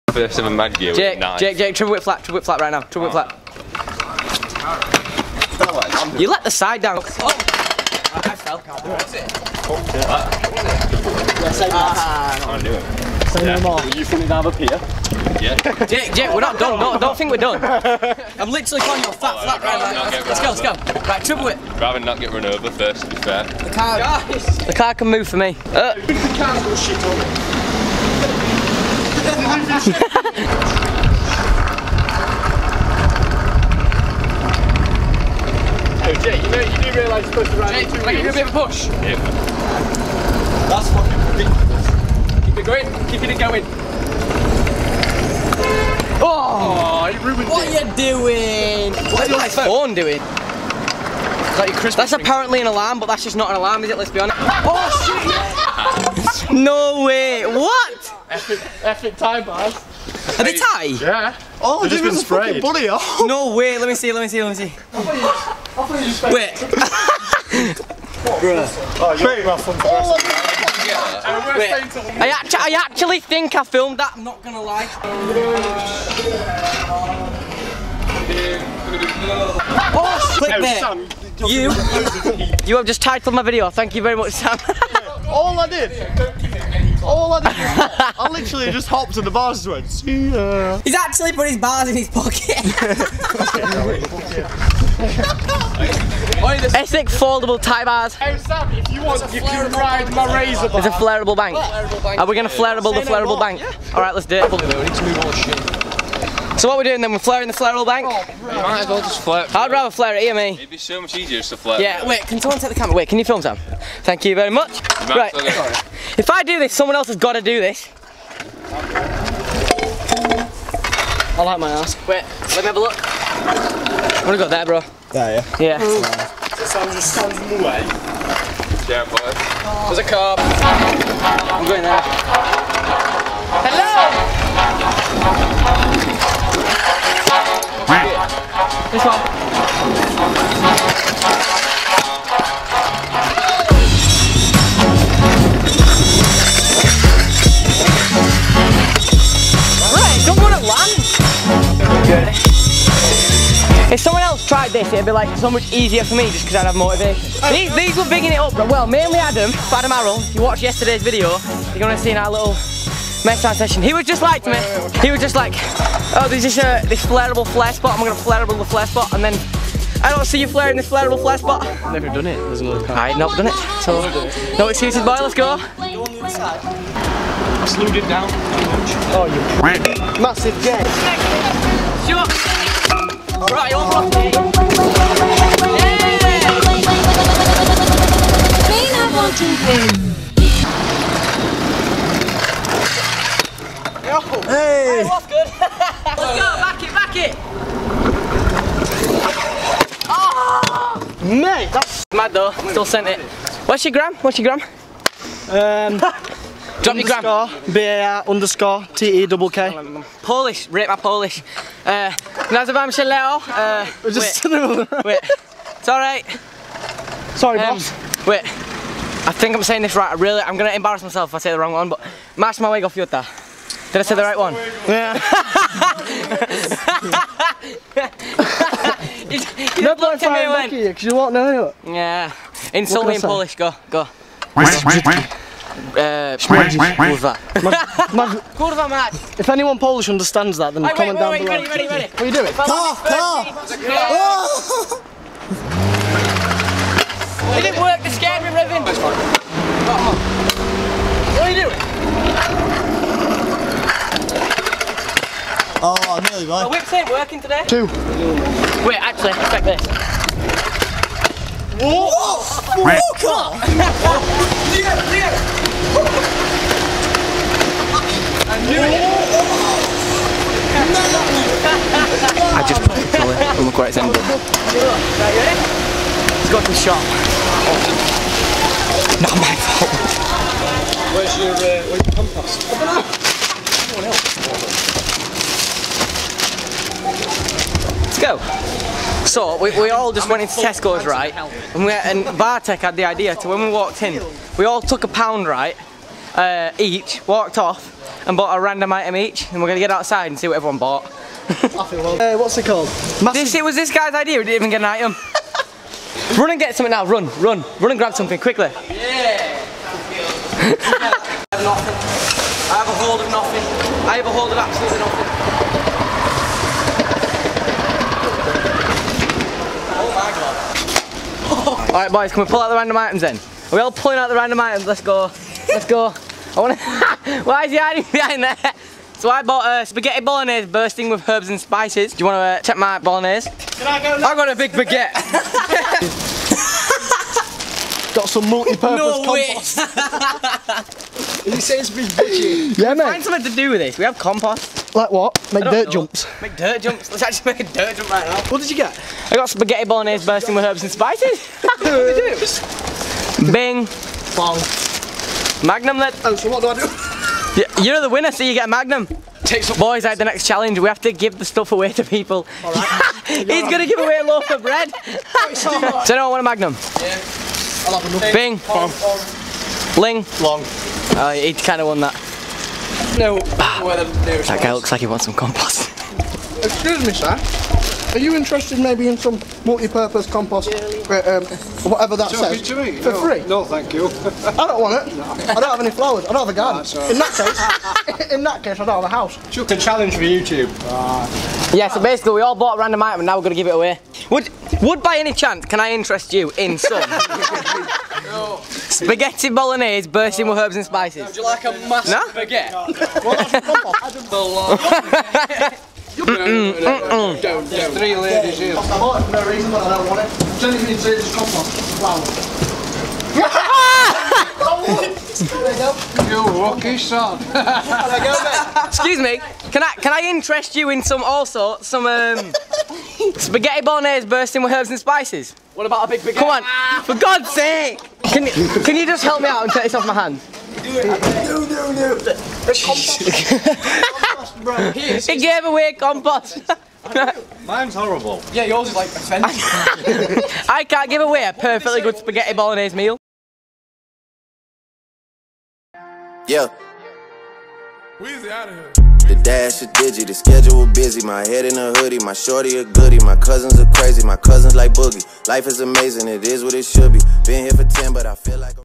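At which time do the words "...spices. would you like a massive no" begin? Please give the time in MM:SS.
06:40.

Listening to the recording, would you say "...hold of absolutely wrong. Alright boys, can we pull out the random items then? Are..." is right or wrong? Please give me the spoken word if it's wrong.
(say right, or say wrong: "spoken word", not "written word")
wrong: "nothing", not "wrong".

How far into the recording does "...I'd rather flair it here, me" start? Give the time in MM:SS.
01:49.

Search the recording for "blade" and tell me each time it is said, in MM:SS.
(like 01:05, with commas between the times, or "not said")
not said.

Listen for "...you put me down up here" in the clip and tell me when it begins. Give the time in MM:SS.
00:13.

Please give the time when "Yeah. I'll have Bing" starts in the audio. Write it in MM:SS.
06:06.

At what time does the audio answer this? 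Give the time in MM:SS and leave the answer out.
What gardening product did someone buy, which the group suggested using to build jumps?
05:38.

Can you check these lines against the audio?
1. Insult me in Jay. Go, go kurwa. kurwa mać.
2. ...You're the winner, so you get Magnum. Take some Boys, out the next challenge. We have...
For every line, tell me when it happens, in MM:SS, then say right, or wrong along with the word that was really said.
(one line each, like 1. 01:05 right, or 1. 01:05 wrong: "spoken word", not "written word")
1. 03:52 wrong: "Polish", not "Jay"
2. 05:57 right.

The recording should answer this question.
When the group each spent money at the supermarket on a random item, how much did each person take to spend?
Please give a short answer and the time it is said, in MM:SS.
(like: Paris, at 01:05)
a pound, at 04:55.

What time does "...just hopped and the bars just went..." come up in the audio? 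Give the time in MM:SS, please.
01:28.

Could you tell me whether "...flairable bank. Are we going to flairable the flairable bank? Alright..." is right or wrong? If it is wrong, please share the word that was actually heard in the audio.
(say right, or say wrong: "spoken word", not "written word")
right.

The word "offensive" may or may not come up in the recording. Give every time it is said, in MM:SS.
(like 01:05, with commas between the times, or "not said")
07:19.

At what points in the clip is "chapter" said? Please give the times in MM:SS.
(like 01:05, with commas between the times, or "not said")
not said.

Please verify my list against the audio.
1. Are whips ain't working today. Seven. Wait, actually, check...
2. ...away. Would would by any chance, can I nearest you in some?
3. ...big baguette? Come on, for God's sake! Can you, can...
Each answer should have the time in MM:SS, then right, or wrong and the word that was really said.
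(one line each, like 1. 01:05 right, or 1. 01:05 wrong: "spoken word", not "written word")
1. 04:16 wrong: "Two", not "Seven"
2. 06:33 wrong: "interest", not "nearest"
3. 07:06 right.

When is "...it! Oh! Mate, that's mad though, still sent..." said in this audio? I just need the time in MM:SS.
03:17.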